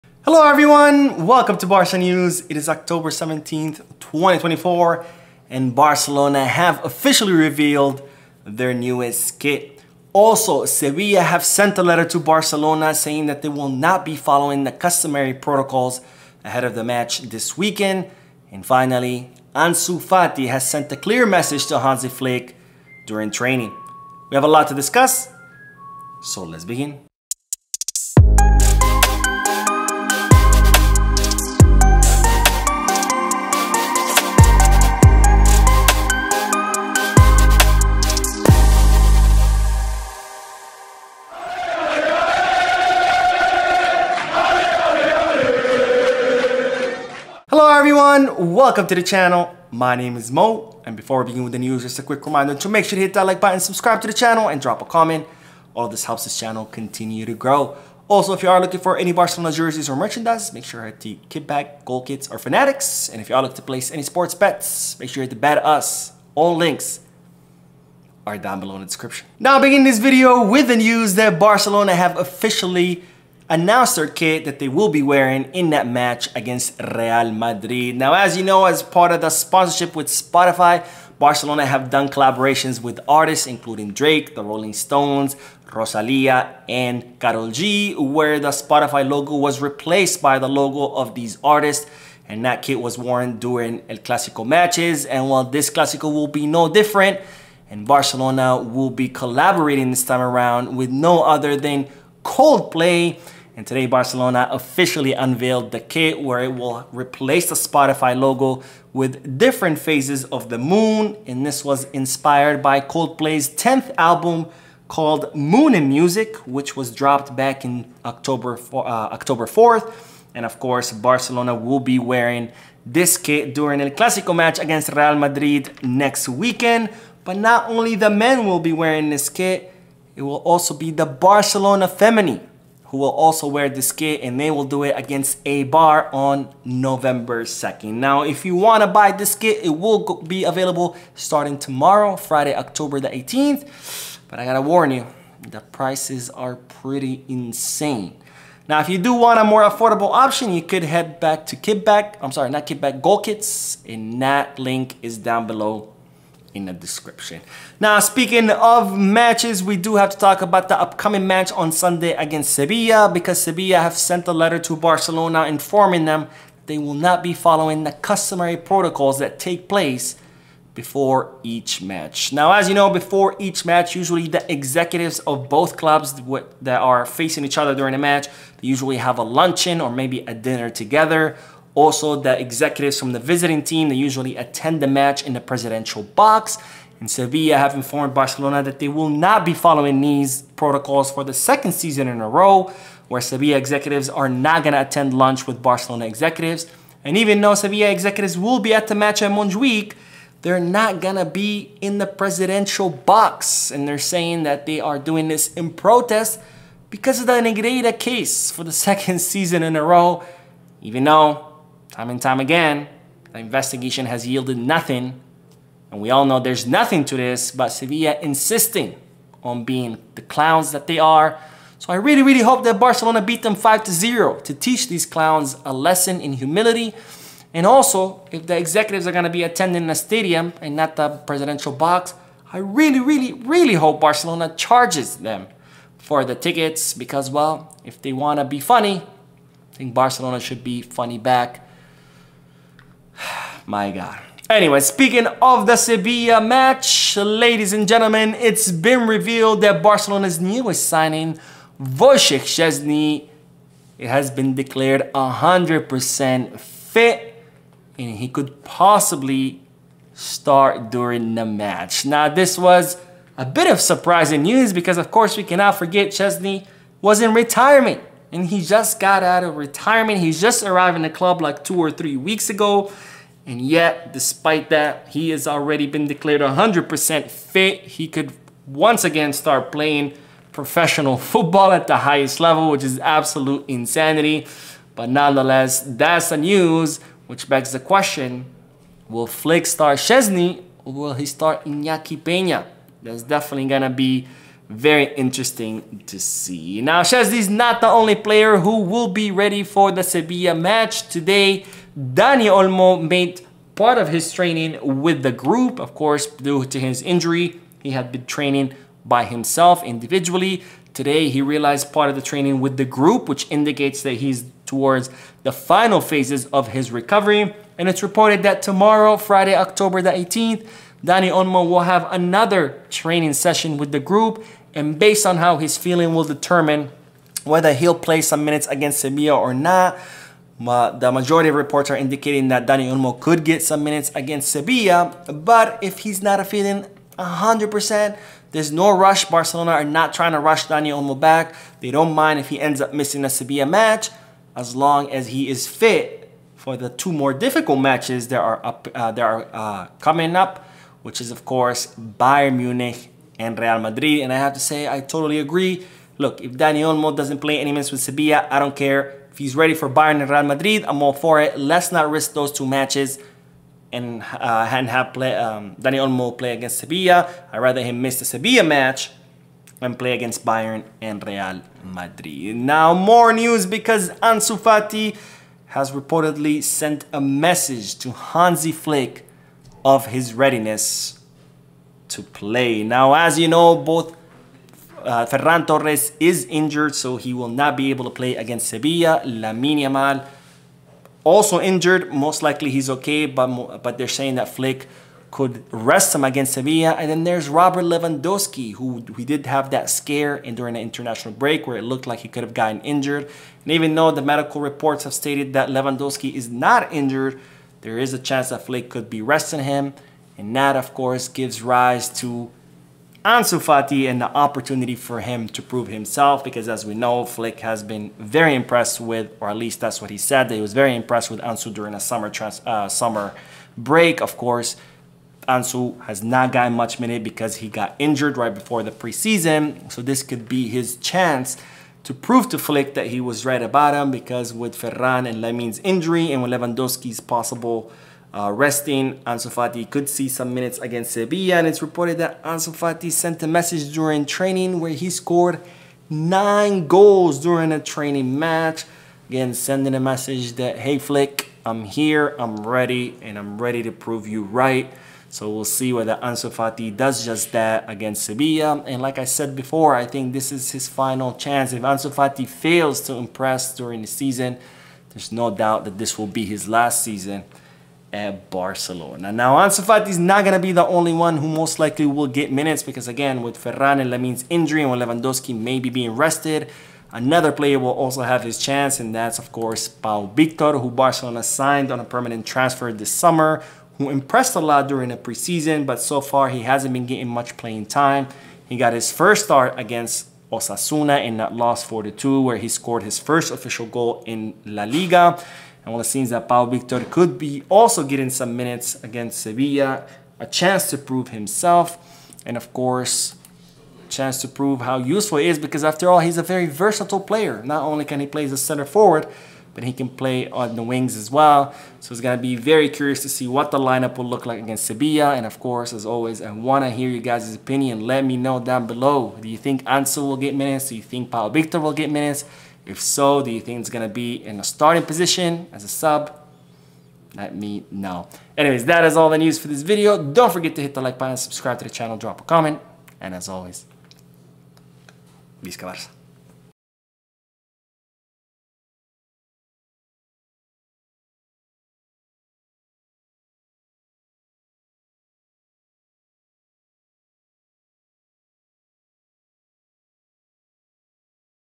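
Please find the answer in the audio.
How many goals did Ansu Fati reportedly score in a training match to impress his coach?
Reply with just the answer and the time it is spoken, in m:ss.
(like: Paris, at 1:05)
9, at 7:26.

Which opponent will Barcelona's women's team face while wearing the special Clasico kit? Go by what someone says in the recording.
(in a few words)
Eibar.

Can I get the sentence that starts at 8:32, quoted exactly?
So it's going to be very curious to see what the lineup will look like against Sevilla.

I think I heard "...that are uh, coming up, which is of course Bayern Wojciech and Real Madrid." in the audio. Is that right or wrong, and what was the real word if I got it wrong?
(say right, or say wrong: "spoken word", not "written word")
wrong: "Munich", not "Wojciech".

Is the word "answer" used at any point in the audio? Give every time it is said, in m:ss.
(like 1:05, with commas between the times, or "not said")
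not said.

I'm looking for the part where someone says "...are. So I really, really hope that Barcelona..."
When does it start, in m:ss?
3:40.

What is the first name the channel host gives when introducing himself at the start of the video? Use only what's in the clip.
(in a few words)
Mo.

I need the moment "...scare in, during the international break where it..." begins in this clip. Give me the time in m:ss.
6:39.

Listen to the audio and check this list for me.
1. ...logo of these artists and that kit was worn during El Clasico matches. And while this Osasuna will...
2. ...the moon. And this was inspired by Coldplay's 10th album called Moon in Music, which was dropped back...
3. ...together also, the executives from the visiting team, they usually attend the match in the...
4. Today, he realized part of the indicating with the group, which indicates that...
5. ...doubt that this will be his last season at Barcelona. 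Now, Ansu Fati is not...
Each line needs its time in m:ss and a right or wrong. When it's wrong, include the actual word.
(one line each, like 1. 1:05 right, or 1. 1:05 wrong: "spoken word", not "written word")
1. 1:30 wrong: "Clasico", not "Osasuna"
2. 1:50 right
3. 3:00 right
4. 5:10 wrong: "training", not "indicating"
5. 7:45 right.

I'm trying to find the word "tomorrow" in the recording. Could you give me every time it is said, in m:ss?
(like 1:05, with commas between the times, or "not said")
2:21, 5:18.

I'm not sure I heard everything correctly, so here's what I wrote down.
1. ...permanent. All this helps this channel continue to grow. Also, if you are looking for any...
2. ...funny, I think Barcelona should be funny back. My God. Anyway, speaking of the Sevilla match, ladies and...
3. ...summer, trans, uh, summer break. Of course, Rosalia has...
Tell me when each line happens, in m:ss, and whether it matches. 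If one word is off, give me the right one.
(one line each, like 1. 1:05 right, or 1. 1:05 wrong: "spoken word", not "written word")
1. 0:54 wrong: "comment", not "permanent"
2. 3:58 right
3. 7:01 wrong: "Ansu", not "Rosalia".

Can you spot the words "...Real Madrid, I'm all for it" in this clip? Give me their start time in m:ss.
6:00.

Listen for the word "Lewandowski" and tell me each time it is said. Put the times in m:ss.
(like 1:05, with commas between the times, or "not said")
6:37, 6:45, 7:16, 7:54.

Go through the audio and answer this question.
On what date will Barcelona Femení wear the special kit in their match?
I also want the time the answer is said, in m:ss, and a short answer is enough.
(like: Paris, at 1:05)
November 2, at 2:16.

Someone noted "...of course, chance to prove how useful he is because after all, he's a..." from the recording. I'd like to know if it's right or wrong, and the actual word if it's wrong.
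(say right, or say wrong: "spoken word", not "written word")
right.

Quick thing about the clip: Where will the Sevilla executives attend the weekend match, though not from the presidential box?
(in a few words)
Montjuic.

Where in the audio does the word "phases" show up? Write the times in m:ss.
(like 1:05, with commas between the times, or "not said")
1:49, 5:15.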